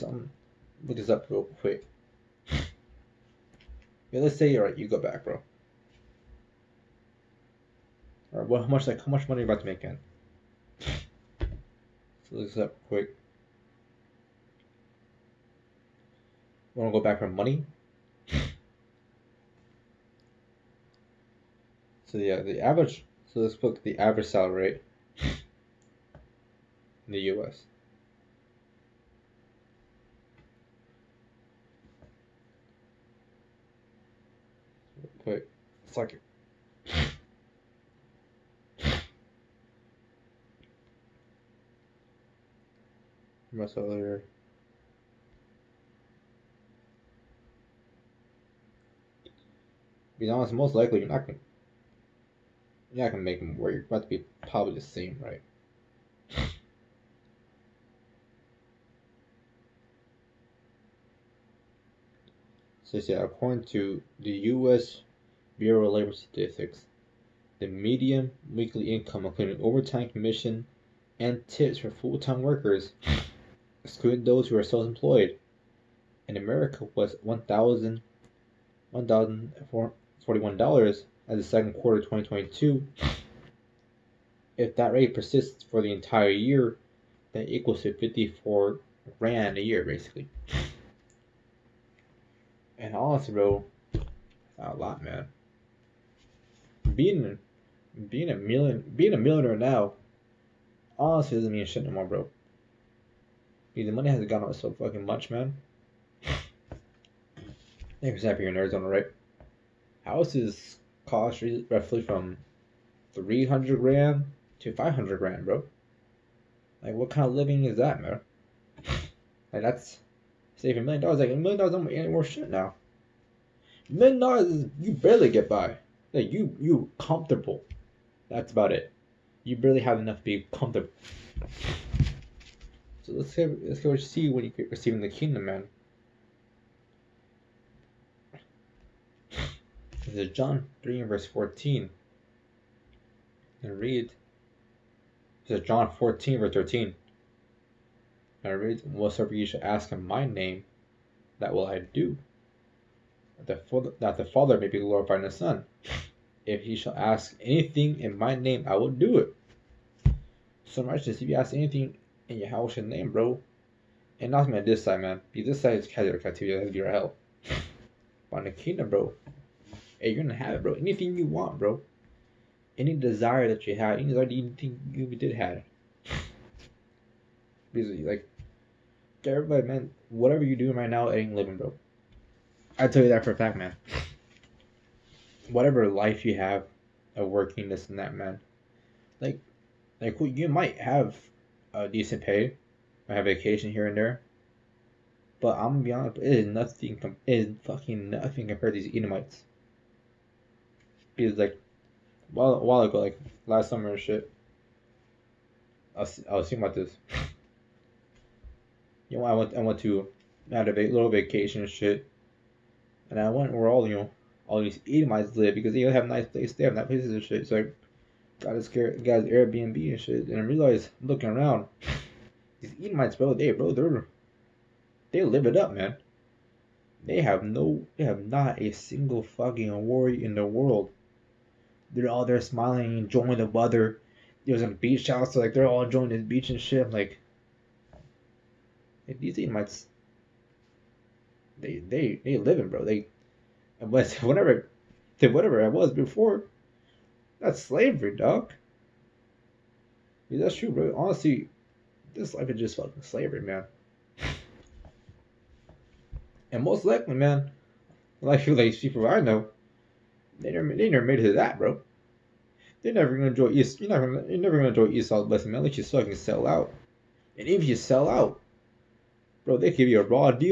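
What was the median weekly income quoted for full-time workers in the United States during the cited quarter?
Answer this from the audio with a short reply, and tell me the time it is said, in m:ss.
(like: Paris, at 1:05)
$1,441, at 1:18.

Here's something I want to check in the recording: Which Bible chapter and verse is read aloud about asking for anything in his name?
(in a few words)
John 14:13.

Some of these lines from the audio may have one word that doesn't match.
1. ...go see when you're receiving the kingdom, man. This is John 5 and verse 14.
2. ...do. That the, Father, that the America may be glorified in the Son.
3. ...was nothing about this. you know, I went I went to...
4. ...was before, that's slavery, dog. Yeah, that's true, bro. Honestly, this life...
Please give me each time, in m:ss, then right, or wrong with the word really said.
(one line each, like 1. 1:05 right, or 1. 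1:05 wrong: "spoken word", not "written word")
1. 2:13 wrong: "3", not "5"
2. 2:31 wrong: "Father", not "America"
3. 3:26 wrong: "thinking", not "nothing"
4. 4:05 right.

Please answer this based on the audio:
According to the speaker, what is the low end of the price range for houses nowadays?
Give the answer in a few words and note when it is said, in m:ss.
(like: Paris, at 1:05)
300 grand, at 1:53.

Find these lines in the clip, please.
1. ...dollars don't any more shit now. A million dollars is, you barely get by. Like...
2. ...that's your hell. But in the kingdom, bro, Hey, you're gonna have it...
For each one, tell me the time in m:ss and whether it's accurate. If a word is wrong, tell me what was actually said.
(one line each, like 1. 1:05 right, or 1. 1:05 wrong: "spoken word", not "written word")
1. 2:01 right
2. 2:46 right.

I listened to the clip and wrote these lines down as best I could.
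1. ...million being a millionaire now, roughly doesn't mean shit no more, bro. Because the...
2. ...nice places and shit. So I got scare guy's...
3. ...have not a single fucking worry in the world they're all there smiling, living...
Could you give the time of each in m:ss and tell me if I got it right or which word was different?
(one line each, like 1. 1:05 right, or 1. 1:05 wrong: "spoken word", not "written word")
1. 1:38 wrong: "honestly", not "roughly"
2. 3:36 right
3. 3:48 wrong: "enjoying", not "living".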